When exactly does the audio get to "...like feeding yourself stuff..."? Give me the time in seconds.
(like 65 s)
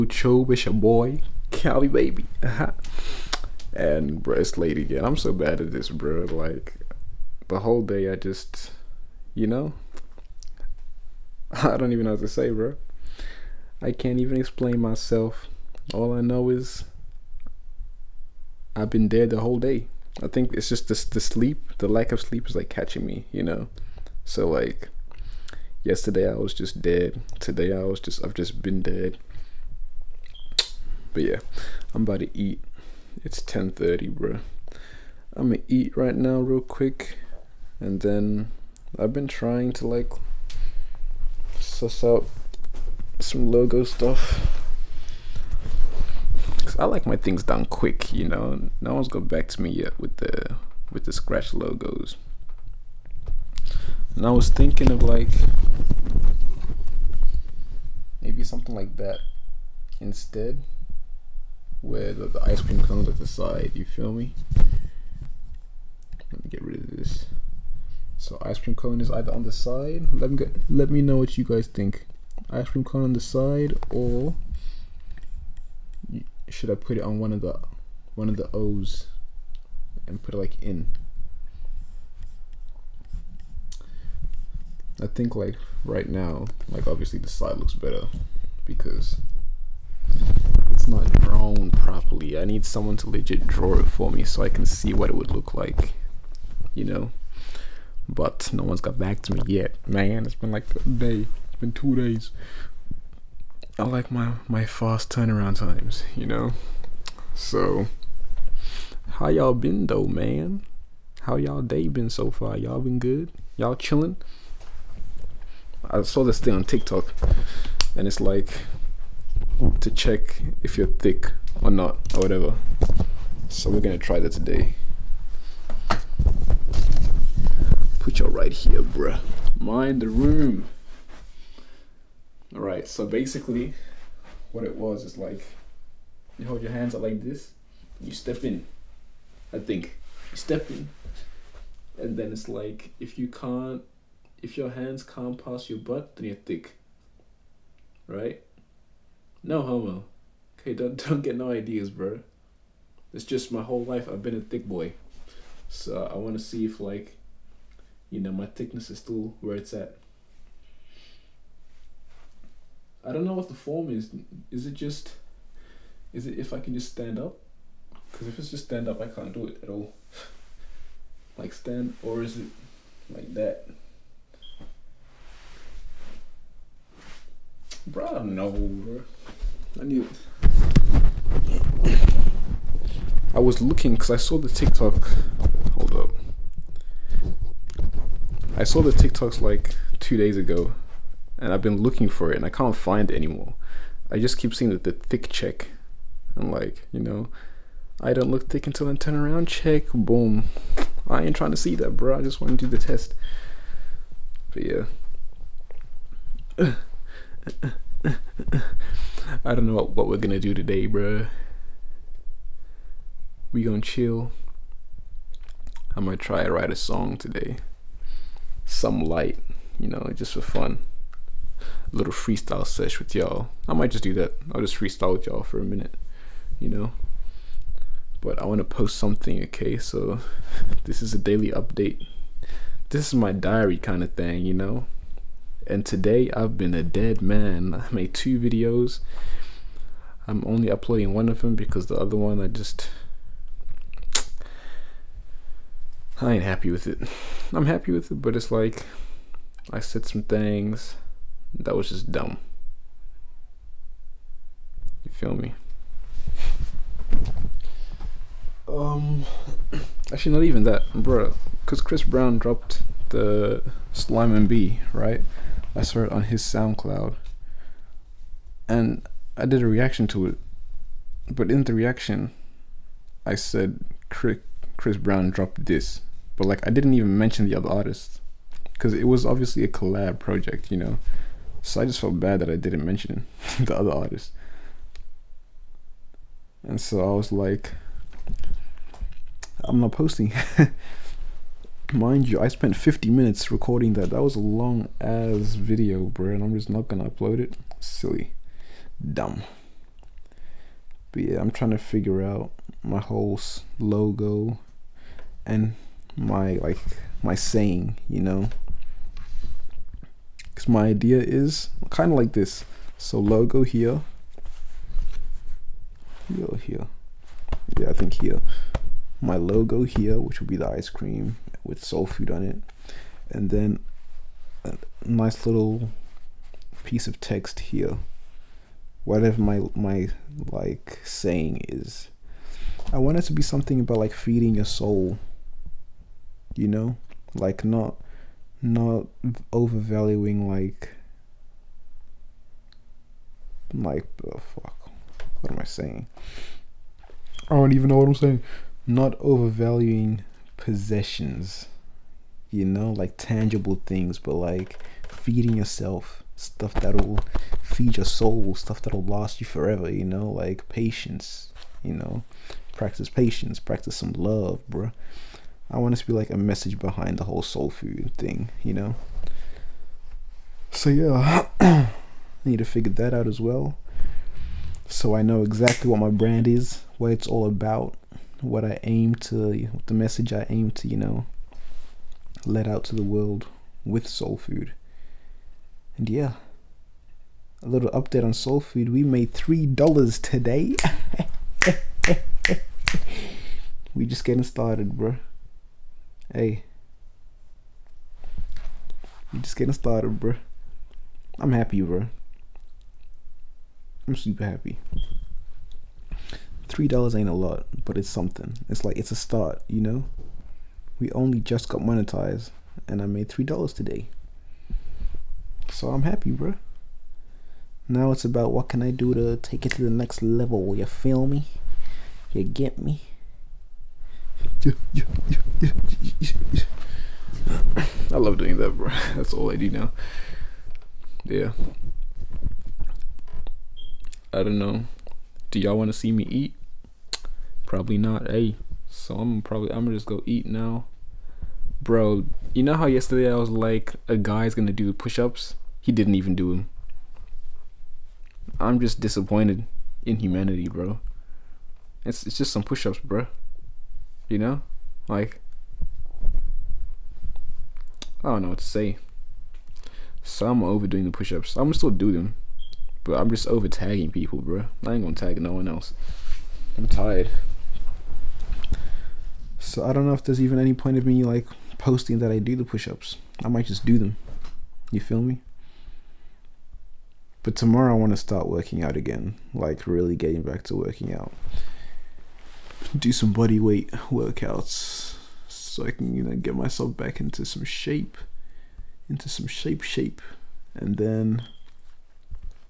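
354 s.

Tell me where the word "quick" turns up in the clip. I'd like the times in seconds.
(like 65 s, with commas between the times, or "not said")
36 s, 47 s.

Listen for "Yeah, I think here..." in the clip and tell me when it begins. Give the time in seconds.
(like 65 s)
317 s.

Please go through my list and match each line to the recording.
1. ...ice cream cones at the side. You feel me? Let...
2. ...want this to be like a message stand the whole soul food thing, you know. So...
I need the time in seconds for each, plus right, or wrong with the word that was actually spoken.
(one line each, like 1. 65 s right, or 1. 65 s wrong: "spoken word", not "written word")
1. 62 s right
2. 365 s wrong: "behind", not "stand".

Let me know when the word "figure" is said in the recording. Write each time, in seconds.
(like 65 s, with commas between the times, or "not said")
301 s, 372 s.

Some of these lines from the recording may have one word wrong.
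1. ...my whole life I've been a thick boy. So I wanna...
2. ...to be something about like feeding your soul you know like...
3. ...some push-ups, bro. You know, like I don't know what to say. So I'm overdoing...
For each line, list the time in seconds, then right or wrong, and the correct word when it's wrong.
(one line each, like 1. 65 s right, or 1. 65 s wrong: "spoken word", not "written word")
1. 153 s right
2. 333 s right
3. 452 s right.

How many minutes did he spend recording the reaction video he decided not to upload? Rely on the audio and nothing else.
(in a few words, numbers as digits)
50.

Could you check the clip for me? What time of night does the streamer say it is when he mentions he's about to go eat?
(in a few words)
10:30.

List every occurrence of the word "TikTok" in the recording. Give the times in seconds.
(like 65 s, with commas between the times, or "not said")
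116 s, 184 s, 188 s.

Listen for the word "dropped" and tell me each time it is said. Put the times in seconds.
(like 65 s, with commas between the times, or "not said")
262 s, 275 s.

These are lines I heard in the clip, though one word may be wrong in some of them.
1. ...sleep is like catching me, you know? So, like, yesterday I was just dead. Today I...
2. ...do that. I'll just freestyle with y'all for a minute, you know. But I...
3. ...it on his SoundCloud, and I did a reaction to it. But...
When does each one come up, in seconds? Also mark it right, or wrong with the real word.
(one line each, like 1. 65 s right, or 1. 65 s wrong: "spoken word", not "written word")
1. 22 s right
2. 224 s right
3. 266 s right.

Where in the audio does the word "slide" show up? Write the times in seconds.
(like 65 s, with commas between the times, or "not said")
87 s.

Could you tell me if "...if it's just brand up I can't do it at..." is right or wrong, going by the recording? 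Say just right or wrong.
wrong.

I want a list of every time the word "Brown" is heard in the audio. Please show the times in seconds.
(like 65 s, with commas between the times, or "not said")
262 s, 274 s.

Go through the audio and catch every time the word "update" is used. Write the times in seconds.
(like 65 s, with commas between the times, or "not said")
231 s, 387 s.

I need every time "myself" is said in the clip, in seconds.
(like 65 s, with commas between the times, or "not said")
14 s, 486 s.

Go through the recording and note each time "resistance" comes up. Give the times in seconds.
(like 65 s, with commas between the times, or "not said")
not said.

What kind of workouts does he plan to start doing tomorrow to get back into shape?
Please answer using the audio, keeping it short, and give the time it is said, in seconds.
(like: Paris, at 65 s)
Body weight workouts, at 483 s.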